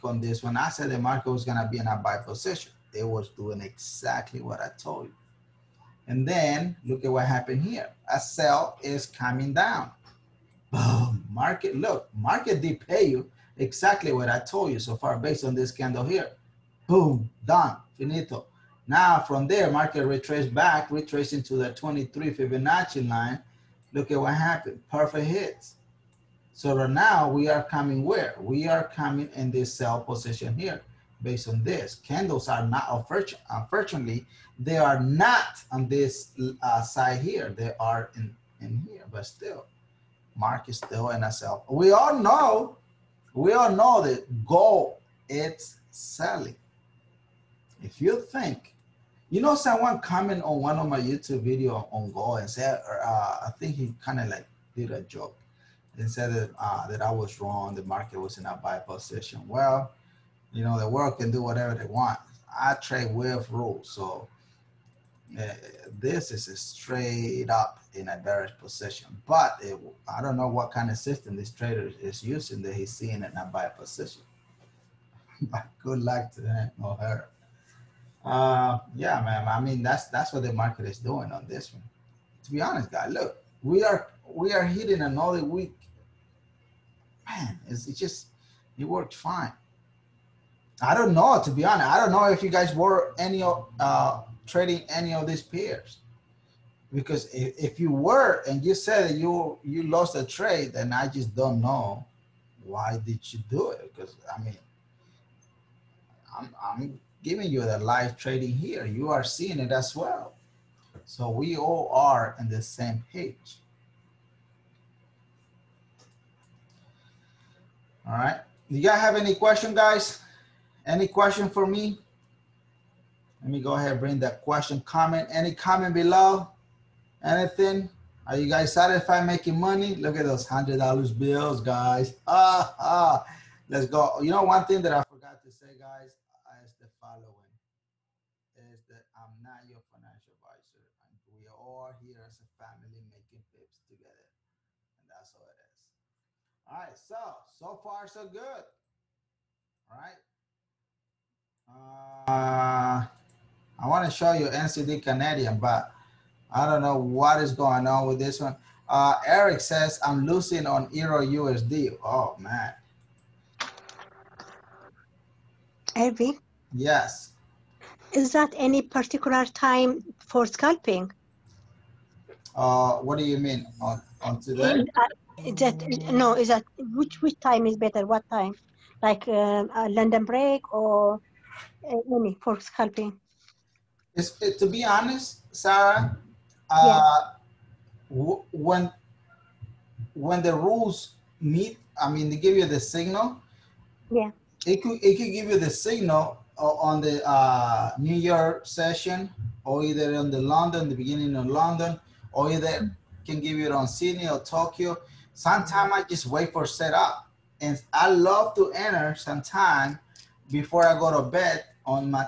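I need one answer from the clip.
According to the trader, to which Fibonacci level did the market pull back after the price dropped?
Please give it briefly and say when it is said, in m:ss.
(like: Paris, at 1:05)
23, at 0:21.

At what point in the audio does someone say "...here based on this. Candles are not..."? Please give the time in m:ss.
0:30.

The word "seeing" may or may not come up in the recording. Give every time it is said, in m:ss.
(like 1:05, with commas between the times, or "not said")
1:12, 1:49.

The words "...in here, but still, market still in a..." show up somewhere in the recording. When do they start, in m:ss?
0:38.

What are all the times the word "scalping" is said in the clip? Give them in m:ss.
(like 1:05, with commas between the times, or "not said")
2:50, 3:02.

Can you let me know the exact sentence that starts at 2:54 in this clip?
Is that, is that, no, is that which which time is better?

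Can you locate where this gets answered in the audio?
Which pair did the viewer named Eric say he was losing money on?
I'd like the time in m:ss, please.
2:40.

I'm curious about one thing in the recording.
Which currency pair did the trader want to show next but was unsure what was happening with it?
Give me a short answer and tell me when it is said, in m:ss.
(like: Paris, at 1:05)
NZD Canadian, at 2:34.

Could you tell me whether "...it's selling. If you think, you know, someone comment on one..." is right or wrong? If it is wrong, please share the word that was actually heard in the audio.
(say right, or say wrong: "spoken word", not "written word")
right.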